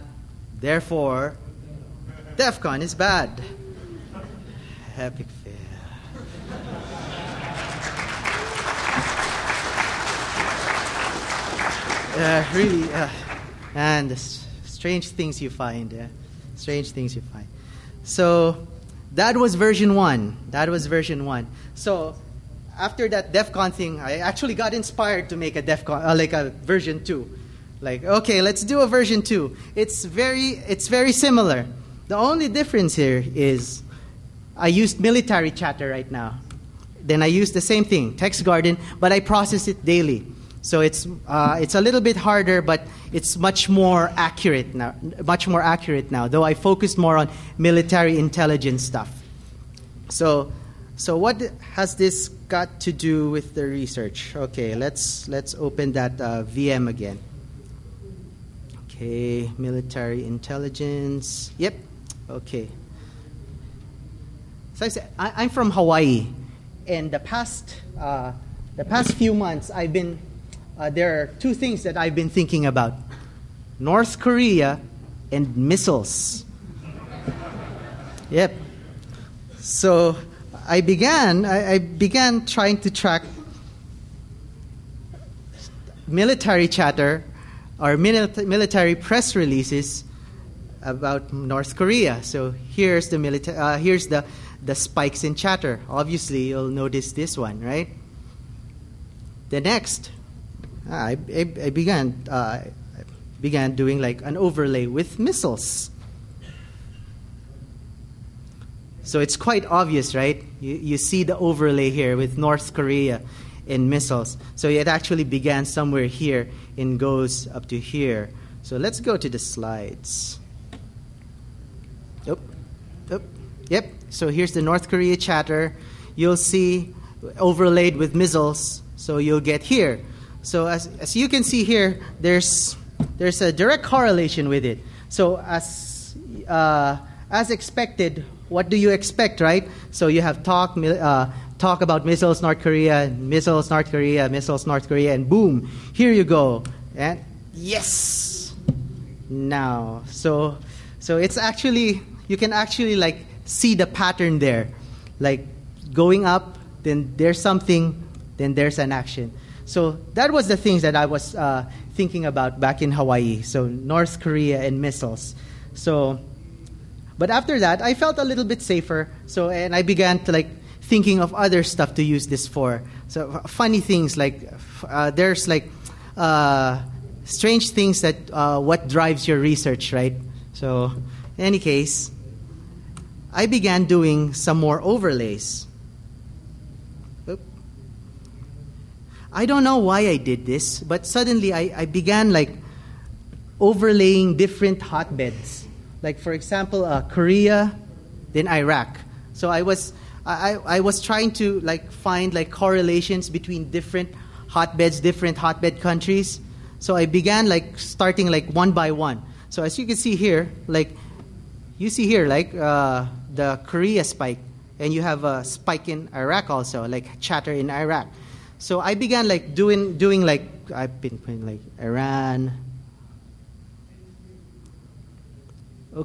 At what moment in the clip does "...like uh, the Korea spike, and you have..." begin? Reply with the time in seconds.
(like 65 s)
212 s.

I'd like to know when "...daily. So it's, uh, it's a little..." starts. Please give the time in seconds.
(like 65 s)
39 s.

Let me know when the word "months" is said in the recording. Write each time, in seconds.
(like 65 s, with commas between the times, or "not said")
69 s.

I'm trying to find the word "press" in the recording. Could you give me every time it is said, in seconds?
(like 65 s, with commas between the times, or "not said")
88 s.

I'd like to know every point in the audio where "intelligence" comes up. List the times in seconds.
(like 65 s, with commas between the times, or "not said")
48 s, 60 s.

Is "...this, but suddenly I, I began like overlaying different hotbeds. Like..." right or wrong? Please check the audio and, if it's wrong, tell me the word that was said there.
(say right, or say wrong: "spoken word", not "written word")
right.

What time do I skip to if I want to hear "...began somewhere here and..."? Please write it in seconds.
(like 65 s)
115 s.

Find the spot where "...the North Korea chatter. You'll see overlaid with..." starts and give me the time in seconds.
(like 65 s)
124 s.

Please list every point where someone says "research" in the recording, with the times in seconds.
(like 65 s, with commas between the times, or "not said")
53 s, 179 s.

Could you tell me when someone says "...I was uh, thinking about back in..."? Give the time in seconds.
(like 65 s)
160 s.